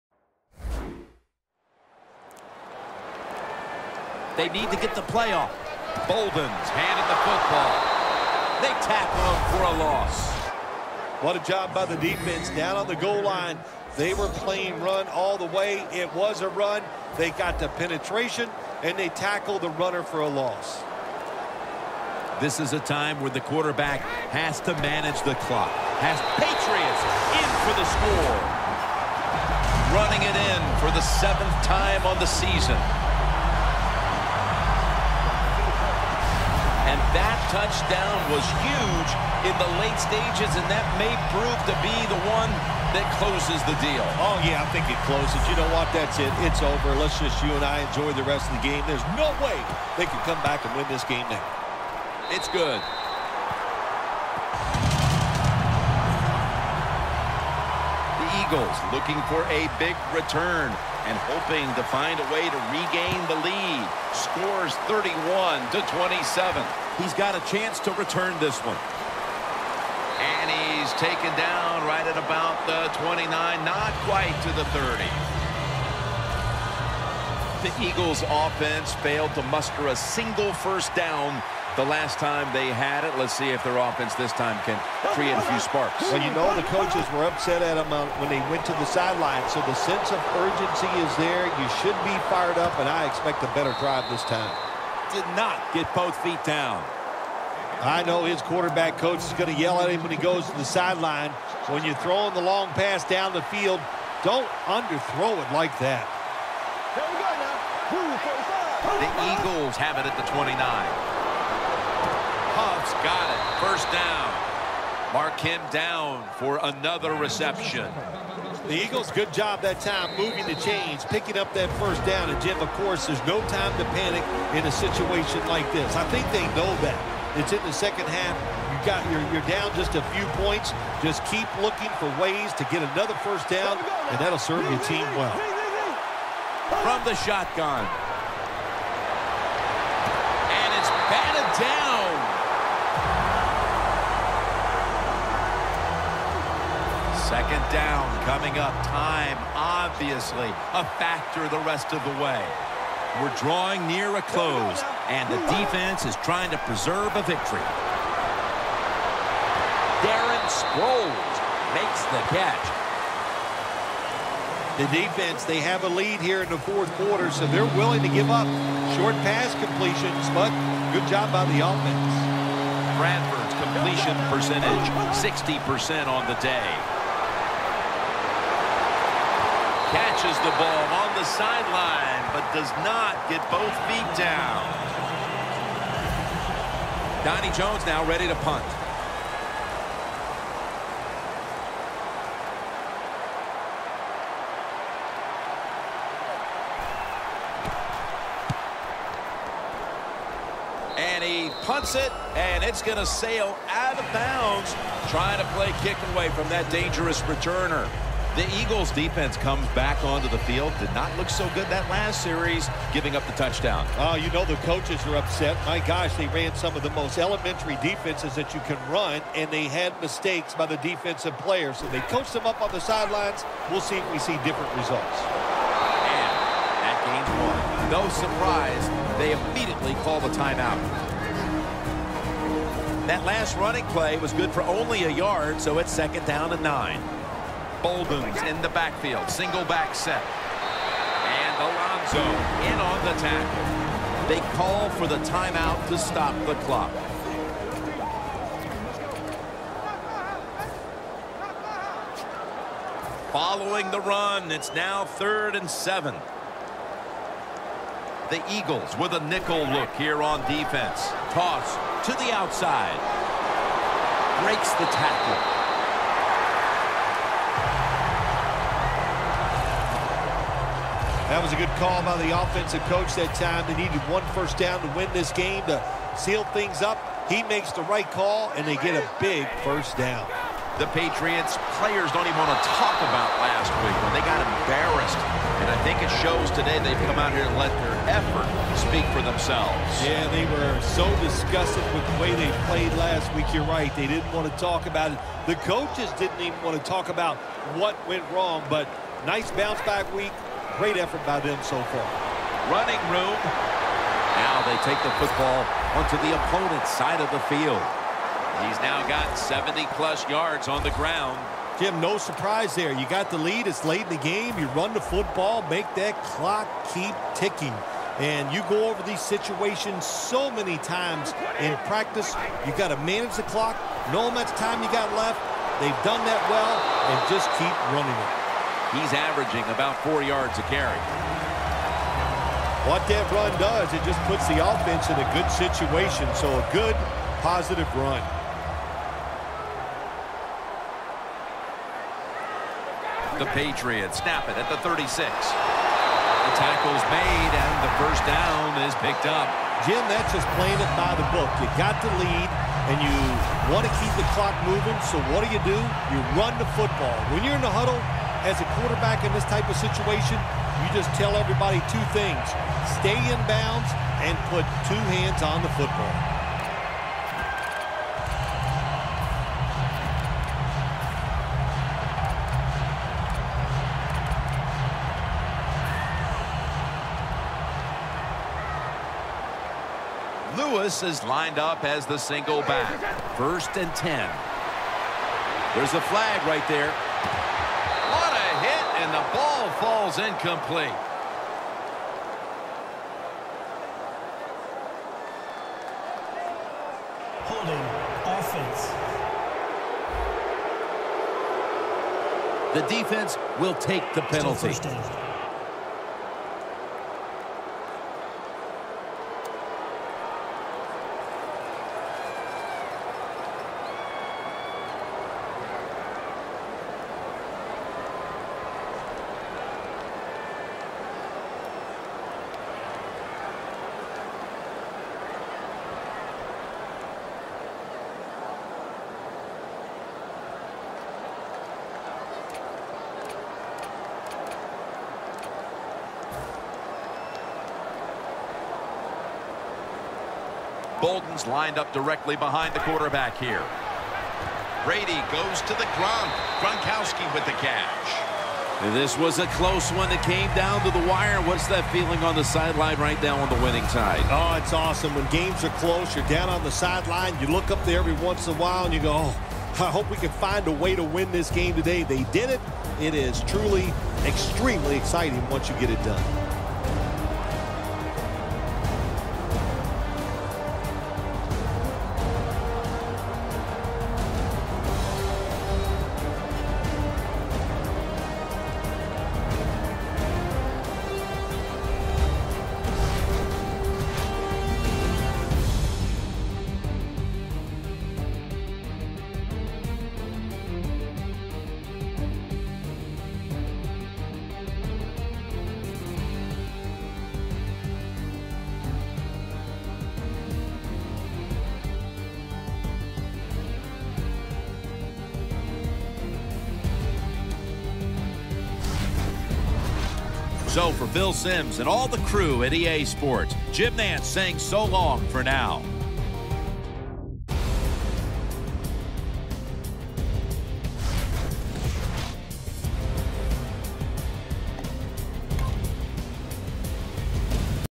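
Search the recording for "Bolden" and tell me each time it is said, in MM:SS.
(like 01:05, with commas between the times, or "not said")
00:06, 03:57, 07:21.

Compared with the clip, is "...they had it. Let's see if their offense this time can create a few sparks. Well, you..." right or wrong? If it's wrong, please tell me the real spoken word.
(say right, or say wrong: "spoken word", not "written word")
right.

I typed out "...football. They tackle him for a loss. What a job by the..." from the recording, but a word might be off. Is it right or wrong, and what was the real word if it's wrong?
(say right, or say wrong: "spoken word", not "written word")
right.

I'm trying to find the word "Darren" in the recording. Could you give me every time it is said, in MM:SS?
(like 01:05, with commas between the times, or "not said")
02:39.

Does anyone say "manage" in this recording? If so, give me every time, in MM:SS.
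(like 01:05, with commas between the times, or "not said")
00:24, 05:22.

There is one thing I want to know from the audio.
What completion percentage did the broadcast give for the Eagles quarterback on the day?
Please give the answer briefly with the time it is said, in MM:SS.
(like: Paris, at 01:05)
60%, at 02:55.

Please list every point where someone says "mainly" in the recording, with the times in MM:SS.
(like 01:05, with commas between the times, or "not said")
not said.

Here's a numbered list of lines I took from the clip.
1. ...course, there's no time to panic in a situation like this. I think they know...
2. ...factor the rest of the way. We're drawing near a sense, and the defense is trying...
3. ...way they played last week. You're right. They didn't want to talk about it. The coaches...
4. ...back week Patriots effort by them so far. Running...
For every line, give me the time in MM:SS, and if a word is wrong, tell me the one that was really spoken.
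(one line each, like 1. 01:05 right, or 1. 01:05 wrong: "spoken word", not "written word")
1. 02:02 right
2. 02:30 wrong: "close", not "sense"
3. 04:52 right
4. 04:59 wrong: "Great", not "Patriots".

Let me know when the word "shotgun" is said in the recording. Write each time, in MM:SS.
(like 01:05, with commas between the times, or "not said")
02:17.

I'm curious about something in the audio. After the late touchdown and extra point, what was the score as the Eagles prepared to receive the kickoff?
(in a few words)
31 to 27.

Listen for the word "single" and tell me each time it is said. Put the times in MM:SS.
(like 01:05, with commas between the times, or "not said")
01:19, 03:59, 06:22.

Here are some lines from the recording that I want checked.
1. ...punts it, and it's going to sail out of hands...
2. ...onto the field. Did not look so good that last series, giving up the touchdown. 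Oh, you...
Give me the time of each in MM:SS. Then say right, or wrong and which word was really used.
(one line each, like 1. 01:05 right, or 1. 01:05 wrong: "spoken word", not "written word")
1. 03:21 wrong: "bounds", not "hands"
2. 03:30 right.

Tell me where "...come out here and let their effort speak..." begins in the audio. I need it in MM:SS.
04:47.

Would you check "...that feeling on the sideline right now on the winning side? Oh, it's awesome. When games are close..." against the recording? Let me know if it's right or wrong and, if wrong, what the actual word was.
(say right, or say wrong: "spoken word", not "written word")
right.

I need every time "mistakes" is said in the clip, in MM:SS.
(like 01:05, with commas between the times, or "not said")
03:40.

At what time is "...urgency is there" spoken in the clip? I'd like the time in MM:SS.
01:30.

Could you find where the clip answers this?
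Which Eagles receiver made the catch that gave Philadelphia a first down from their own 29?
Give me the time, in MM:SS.
01:52.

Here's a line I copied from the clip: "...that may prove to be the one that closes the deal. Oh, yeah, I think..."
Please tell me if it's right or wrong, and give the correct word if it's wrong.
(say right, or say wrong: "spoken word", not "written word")
right.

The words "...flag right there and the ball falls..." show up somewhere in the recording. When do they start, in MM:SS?
06:26.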